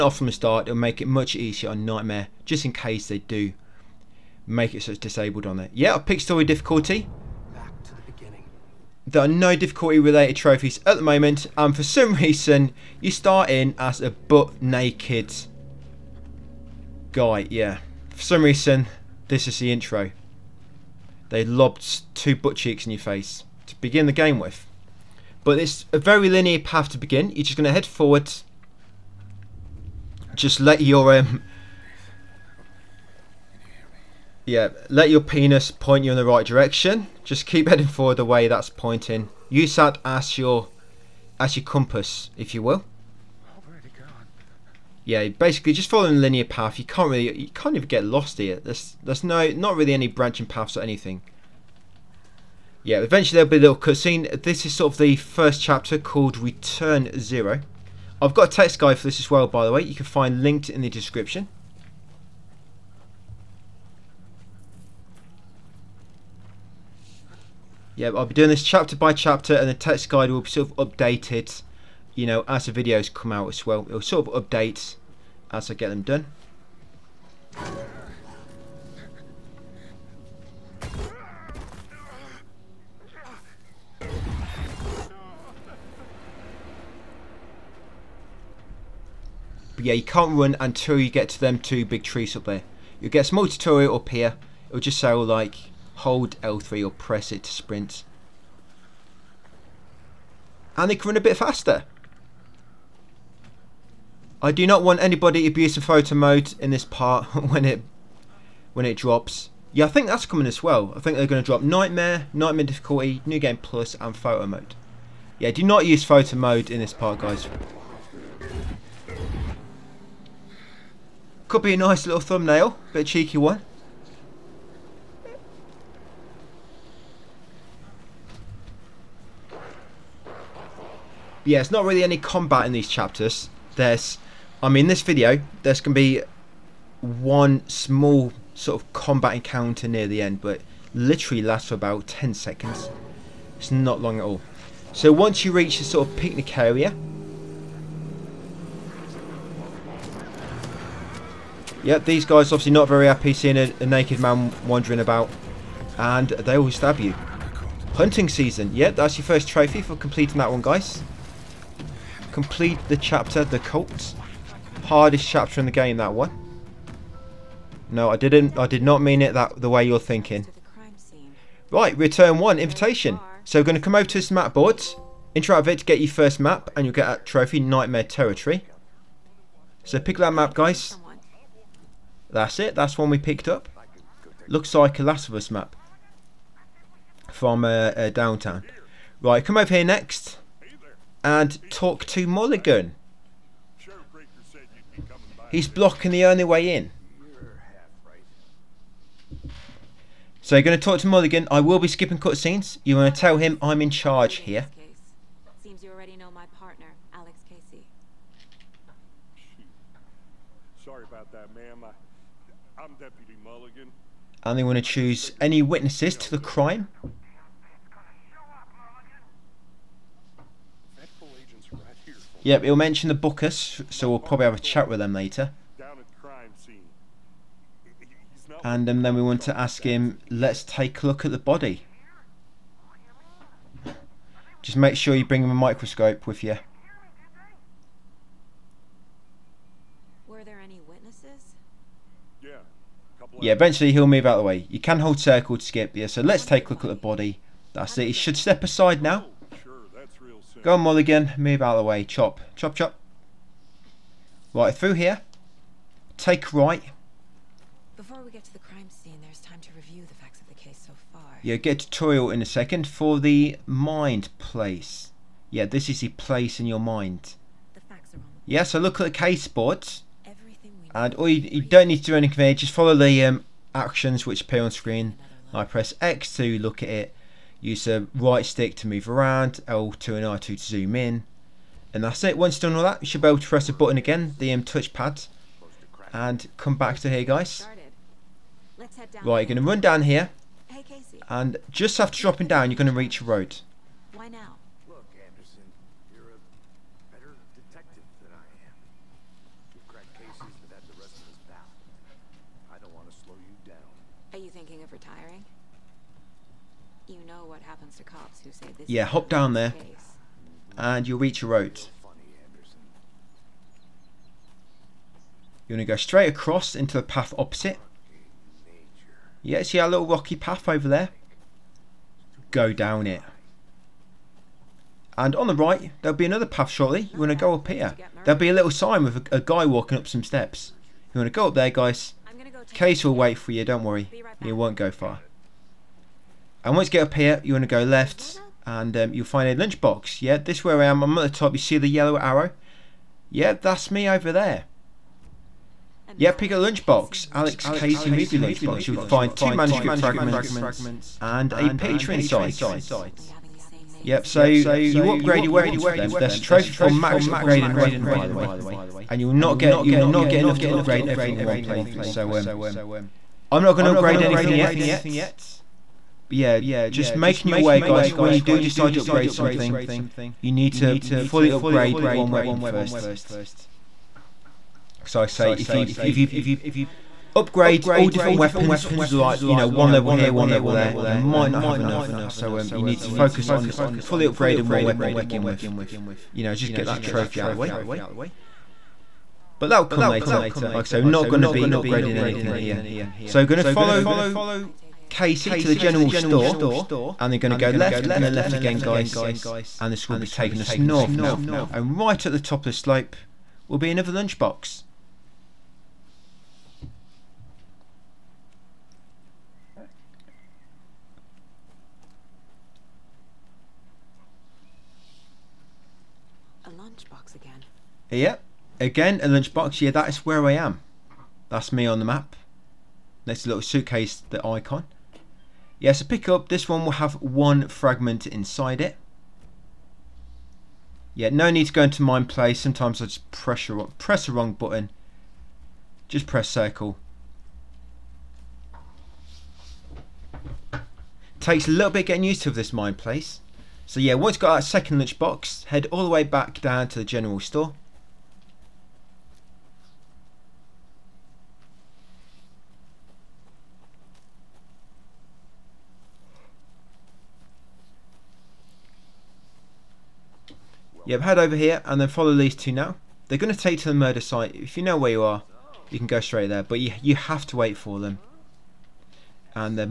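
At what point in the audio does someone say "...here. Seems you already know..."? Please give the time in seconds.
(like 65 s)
204 s.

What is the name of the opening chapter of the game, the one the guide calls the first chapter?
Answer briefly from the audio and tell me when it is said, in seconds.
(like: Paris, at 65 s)
Return Zero, at 56 s.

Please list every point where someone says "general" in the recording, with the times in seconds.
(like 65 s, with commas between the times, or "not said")
395 s, 447 s.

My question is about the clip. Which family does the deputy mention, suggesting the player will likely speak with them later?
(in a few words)
The Bookers.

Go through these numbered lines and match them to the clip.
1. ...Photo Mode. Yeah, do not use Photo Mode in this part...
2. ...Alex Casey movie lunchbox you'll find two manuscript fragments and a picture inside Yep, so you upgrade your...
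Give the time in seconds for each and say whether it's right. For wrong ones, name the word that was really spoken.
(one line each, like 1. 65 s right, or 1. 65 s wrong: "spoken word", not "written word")
1. 114 s right
2. 347 s right.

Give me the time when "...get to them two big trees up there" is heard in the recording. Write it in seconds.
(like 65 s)
91 s.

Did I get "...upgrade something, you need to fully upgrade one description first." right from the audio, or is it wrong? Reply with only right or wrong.
wrong.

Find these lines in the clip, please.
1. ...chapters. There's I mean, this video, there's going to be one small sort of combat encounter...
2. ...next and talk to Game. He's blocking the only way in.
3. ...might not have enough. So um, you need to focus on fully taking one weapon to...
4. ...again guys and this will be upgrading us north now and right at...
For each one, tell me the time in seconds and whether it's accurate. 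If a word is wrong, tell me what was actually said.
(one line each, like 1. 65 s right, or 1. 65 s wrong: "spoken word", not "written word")
1. 132 s right
2. 189 s wrong: "Mulligan", not "Game"
3. 381 s wrong: "upgrading", not "taking"
4. 398 s wrong: "taking", not "upgrading".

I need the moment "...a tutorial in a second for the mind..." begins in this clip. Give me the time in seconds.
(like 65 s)
261 s.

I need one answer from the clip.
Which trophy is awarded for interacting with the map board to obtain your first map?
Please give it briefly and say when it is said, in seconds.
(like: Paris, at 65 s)
Nightmare Territory, at 177 s.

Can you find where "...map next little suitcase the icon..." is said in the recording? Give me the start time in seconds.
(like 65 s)
422 s.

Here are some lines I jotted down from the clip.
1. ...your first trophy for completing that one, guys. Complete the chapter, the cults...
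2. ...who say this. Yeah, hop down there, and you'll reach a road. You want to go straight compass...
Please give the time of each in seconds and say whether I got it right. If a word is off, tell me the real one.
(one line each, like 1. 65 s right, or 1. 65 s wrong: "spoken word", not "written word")
1. 159 s right
2. 308 s wrong: "across", not "compass".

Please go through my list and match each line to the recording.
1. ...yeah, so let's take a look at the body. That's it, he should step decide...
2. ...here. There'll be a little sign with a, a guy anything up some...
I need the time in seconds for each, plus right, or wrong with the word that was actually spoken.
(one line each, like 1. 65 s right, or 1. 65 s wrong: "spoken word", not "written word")
1. 245 s wrong: "aside", not "decide"
2. 327 s wrong: "walking", not "anything".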